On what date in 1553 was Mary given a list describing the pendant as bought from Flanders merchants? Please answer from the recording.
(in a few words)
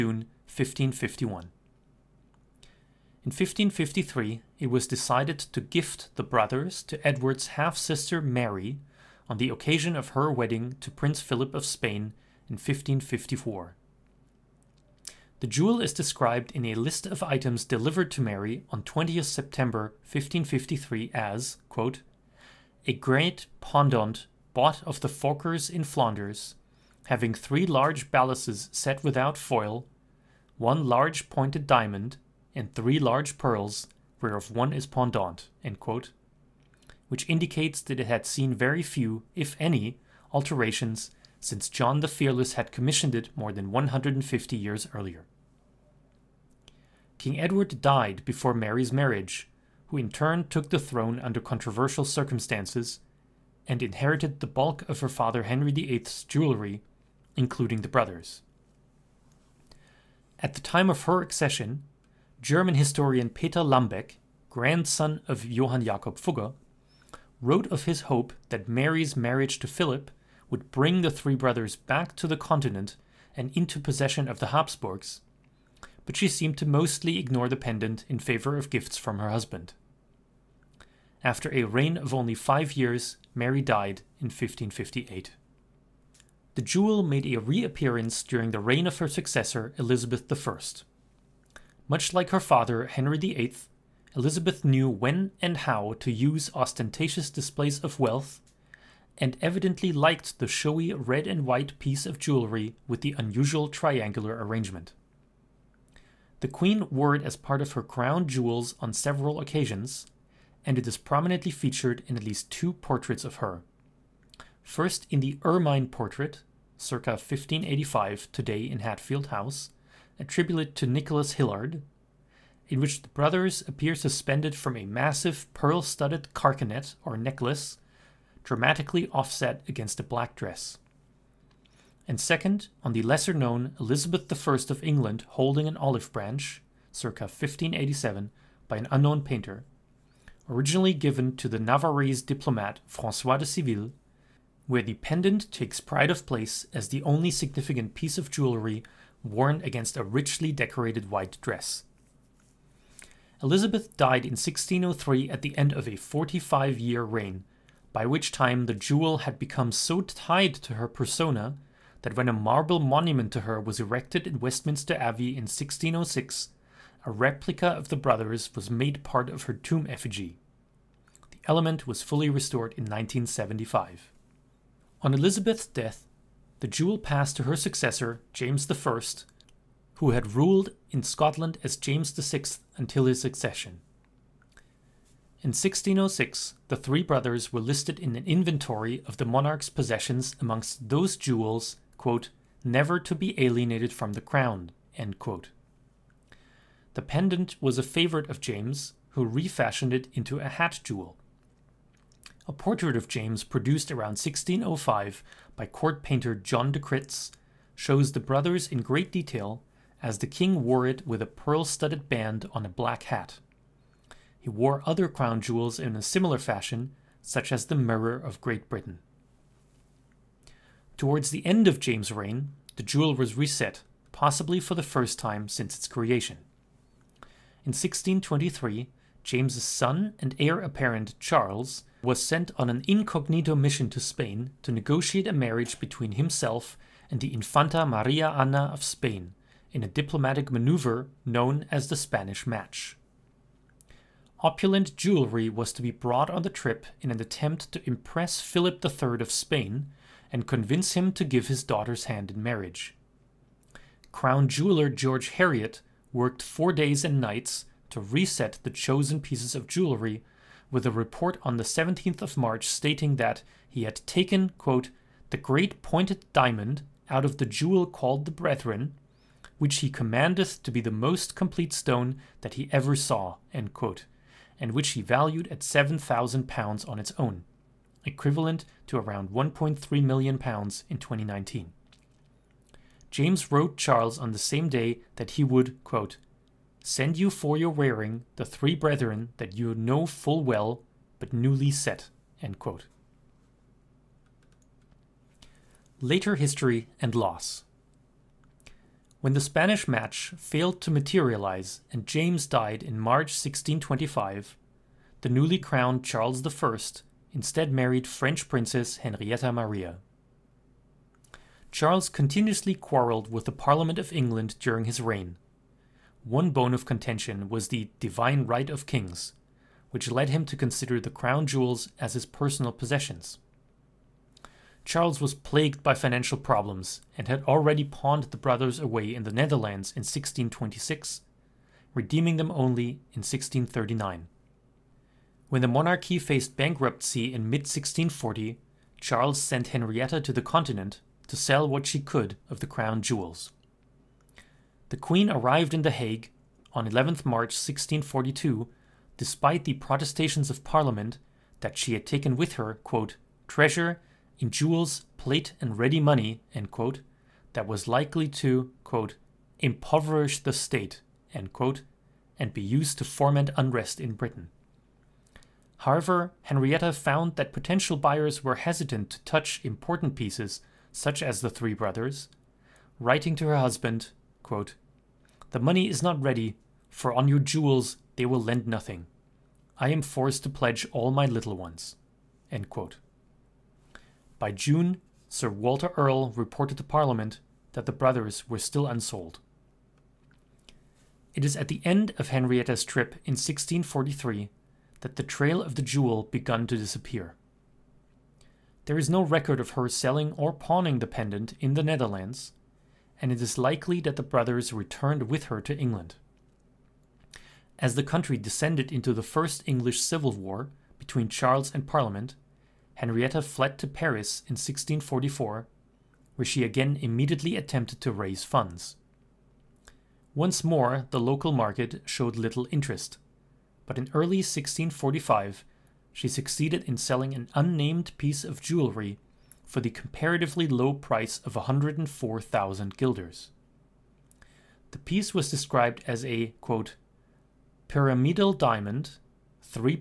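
20 September.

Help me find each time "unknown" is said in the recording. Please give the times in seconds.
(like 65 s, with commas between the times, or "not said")
138 s.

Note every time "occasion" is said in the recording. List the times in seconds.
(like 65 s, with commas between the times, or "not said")
9 s, 109 s.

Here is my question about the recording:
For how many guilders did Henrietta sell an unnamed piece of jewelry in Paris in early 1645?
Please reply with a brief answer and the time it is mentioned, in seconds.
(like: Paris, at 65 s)
104,000 guilders, at 431 s.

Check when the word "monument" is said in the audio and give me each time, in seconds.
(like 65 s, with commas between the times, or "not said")
162 s.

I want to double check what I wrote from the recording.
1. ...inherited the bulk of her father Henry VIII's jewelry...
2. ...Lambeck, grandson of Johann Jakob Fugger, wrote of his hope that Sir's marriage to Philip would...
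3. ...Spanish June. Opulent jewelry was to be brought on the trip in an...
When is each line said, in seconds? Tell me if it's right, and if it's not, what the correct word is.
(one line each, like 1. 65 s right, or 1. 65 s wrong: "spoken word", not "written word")
1. 53 s right
2. 63 s wrong: "Mary", not "Sir"
3. 241 s wrong: "Match", not "June".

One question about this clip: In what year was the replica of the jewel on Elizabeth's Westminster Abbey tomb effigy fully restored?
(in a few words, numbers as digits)
1975.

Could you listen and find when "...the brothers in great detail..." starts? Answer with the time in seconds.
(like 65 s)
208 s.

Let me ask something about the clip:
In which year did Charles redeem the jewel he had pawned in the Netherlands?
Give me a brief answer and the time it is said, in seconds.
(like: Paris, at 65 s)
1639, at 333 s.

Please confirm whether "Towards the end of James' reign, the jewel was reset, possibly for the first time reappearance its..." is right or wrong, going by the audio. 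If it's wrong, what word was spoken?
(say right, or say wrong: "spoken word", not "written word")
wrong: "since", not "reappearance".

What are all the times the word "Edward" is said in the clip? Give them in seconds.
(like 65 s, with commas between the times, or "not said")
7 s, 47 s.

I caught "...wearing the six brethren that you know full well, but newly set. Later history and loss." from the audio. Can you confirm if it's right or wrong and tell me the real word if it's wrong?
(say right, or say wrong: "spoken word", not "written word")
wrong: "three", not "six".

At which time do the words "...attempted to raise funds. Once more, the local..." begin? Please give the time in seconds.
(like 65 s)
417 s.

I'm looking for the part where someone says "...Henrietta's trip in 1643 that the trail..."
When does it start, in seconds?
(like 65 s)
392 s.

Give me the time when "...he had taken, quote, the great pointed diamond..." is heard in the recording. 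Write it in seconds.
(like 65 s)
263 s.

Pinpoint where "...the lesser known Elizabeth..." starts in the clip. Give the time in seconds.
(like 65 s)
132 s.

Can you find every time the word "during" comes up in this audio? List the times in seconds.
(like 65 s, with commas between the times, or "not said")
88 s, 314 s.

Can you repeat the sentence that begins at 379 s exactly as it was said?
I am forced to pledge all my little ones.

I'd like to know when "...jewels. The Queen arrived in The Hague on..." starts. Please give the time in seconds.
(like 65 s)
343 s.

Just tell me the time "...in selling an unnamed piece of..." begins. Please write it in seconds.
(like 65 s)
426 s.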